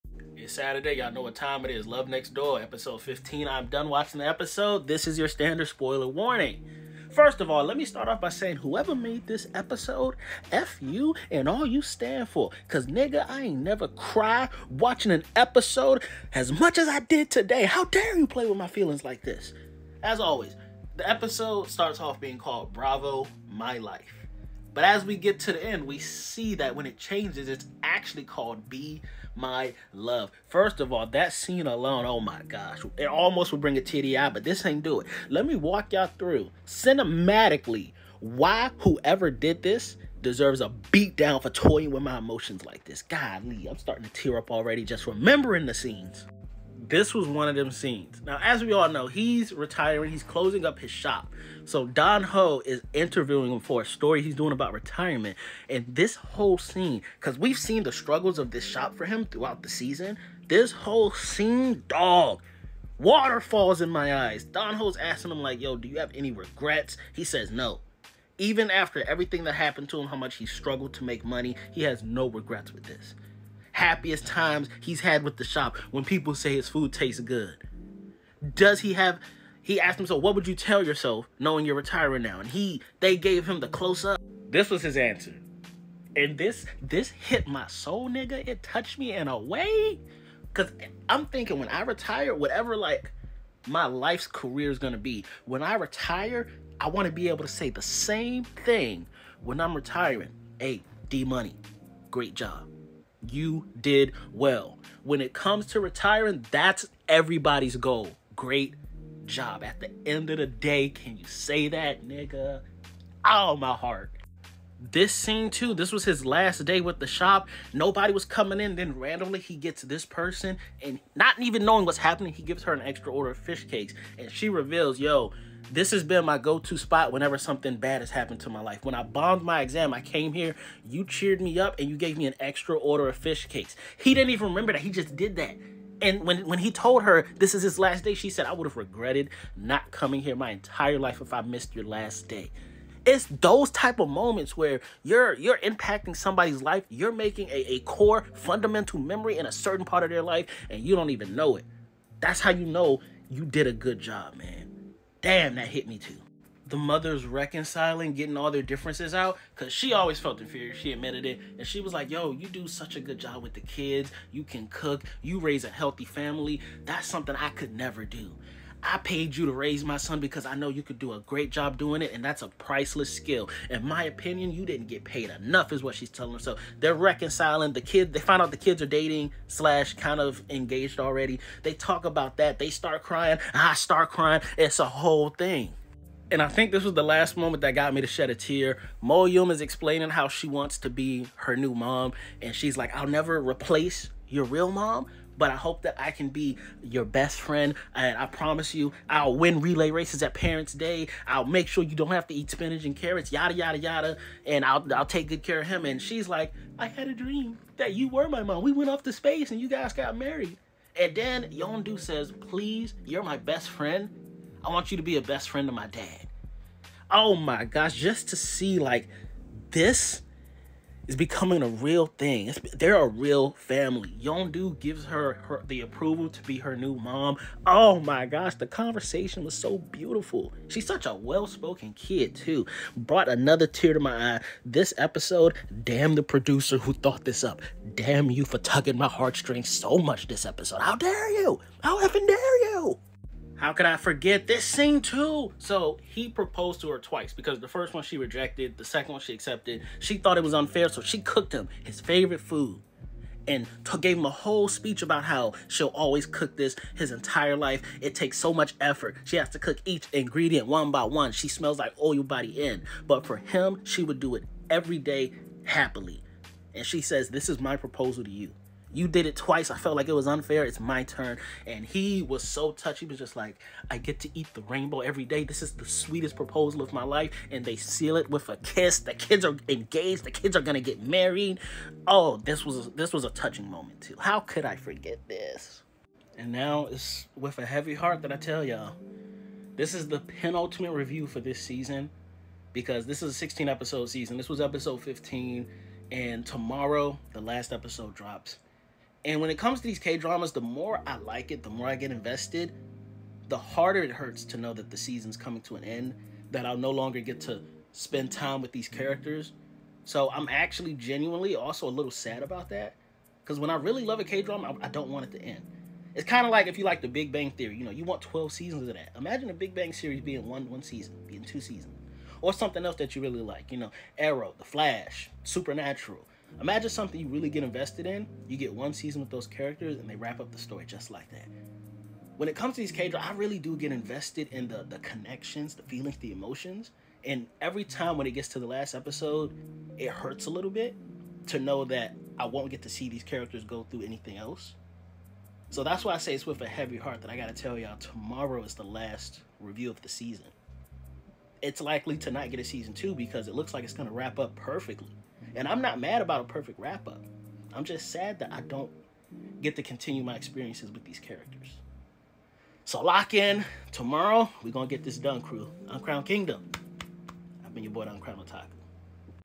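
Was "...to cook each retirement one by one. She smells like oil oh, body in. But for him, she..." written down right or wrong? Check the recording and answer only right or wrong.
wrong.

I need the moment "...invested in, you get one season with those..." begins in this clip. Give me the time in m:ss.
5:27.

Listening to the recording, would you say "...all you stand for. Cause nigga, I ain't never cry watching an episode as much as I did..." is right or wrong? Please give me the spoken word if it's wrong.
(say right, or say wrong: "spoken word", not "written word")
right.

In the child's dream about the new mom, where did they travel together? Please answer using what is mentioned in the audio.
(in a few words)
Space.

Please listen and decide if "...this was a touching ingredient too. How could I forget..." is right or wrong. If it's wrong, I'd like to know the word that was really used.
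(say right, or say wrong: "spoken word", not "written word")
wrong: "moment", not "ingredient".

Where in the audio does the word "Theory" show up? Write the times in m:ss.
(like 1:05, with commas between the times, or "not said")
5:17.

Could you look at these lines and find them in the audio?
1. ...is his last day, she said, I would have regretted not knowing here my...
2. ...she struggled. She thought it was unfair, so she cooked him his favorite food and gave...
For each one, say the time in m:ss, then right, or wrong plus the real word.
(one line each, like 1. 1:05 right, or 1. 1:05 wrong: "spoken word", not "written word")
1. 2:17 wrong: "coming", not "knowing"
2. 4:09 wrong: "accepted", not "struggled".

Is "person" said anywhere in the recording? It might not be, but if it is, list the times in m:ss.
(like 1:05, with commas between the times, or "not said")
2:00.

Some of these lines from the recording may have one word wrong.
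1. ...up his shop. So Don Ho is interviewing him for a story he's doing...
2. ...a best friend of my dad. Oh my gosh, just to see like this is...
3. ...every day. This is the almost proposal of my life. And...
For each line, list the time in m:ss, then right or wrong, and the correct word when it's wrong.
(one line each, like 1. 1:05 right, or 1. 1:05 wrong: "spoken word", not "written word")
1. 0:50 right
2. 3:35 right
3. 4:34 wrong: "sweetest", not "almost".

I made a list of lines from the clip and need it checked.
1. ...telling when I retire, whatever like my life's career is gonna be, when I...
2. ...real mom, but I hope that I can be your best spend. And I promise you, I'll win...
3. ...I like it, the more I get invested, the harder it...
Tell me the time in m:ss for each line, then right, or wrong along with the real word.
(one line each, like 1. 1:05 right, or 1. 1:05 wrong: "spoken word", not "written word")
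1. 1:31 wrong: "thinking", not "telling"
2. 3:14 wrong: "friend", not "spend"
3. 5:01 right.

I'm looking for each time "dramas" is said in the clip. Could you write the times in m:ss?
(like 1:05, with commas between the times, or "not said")
5:00, 5:14, 5:33.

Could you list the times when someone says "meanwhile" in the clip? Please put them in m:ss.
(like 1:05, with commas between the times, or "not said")
not said.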